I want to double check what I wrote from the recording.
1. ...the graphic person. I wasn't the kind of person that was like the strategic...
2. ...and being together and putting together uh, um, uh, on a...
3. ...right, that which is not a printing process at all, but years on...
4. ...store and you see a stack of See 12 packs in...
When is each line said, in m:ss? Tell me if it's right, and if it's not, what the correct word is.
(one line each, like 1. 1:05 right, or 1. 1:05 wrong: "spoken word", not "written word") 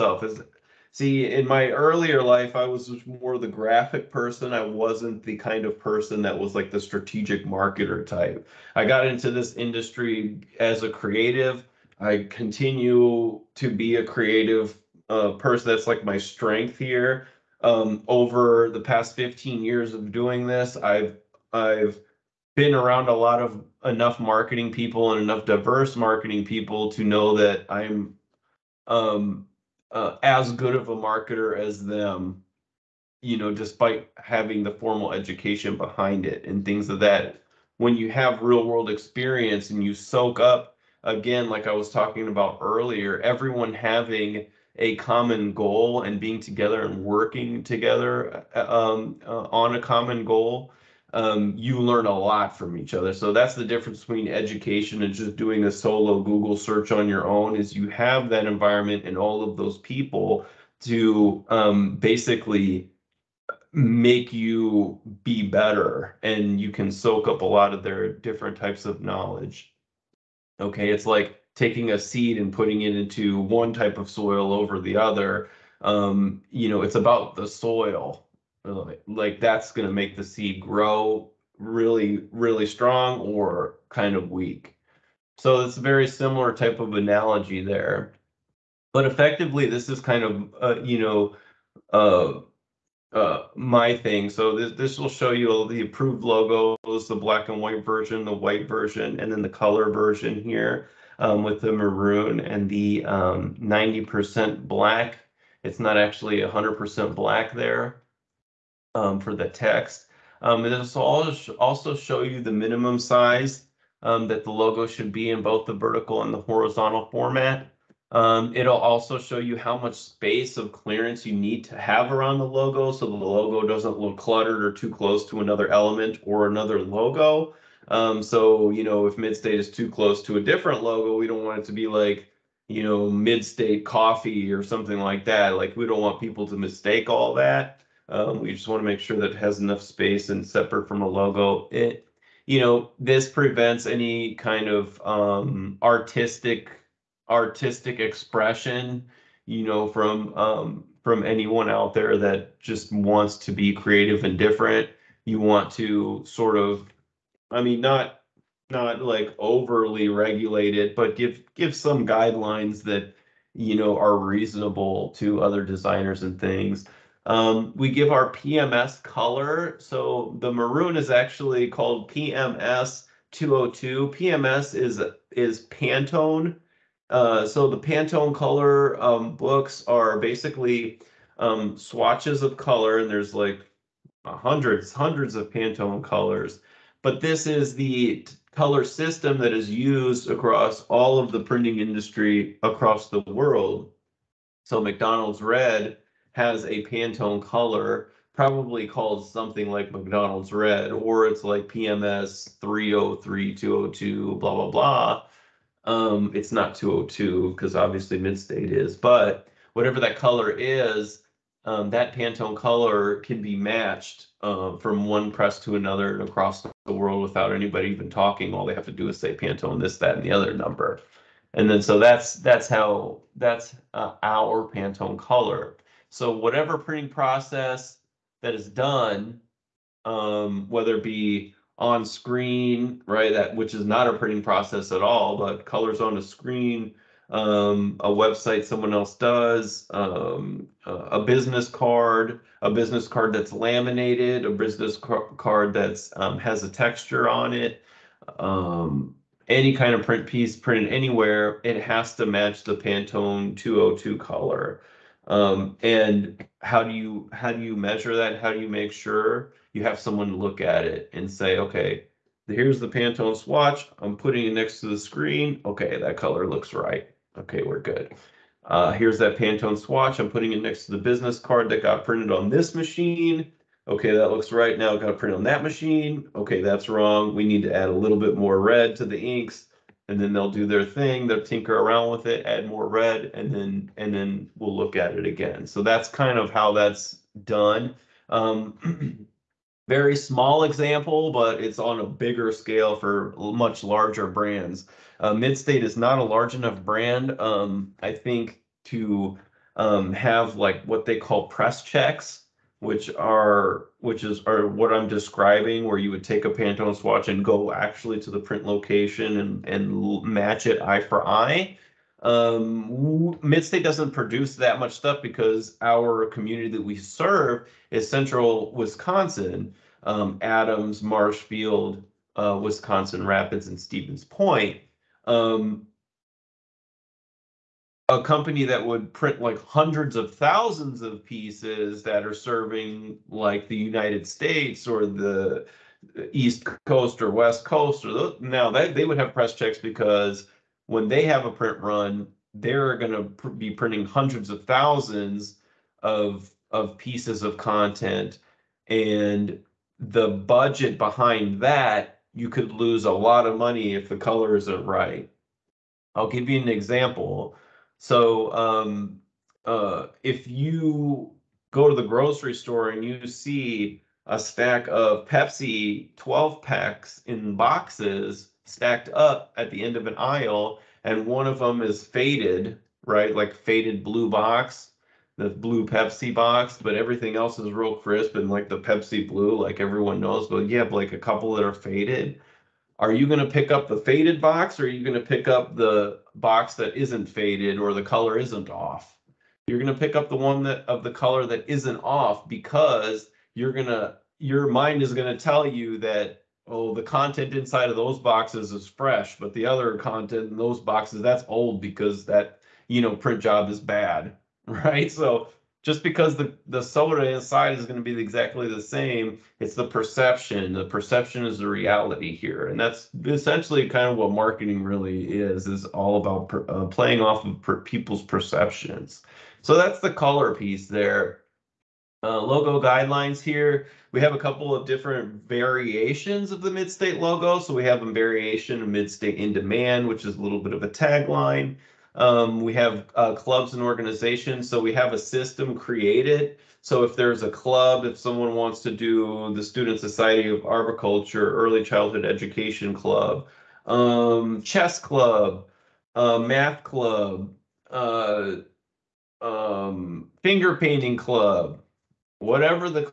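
1. 0:03 right
2. 0:46 wrong: "working", not "putting"
3. 3:53 wrong: "colors", not "years"
4. 6:02 wrong: "Pepsi", not "See".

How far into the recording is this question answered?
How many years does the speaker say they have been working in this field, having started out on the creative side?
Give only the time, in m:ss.
0:19.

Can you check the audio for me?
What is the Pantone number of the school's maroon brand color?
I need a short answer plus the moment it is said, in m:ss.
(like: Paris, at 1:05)
PMS 202, at 2:52.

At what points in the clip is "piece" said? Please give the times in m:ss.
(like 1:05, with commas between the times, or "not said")
4:10, 5:31, 5:46, 7:00.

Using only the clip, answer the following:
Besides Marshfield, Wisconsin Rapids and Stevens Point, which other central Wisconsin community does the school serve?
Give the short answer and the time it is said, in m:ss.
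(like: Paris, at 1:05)
Adams, at 5:20.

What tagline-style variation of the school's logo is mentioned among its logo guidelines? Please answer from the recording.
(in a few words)
Midstate in demand.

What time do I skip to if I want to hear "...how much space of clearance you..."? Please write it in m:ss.
1:59.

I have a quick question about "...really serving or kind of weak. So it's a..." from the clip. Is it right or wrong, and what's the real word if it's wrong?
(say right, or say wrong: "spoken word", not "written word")
wrong: "strong", not "serving".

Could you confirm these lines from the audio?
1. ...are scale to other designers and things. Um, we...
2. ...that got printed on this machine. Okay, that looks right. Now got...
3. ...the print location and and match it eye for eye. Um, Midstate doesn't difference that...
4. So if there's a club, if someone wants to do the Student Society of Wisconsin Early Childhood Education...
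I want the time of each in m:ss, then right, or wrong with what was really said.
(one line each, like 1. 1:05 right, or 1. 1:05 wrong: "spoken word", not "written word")
1. 2:43 wrong: "reasonable", not "scale"
2. 4:31 right
3. 5:08 wrong: "produce", not "difference"
4. 7:16 wrong: "Arboriculture", not "Wisconsin".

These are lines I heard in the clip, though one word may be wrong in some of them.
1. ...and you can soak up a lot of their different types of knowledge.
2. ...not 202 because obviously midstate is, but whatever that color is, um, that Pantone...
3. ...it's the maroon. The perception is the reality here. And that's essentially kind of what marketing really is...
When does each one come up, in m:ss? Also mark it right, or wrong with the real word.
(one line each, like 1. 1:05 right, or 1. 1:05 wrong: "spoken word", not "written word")
1. 1:06 right
2. 3:26 right
3. 6:49 wrong: "perception", not "maroon".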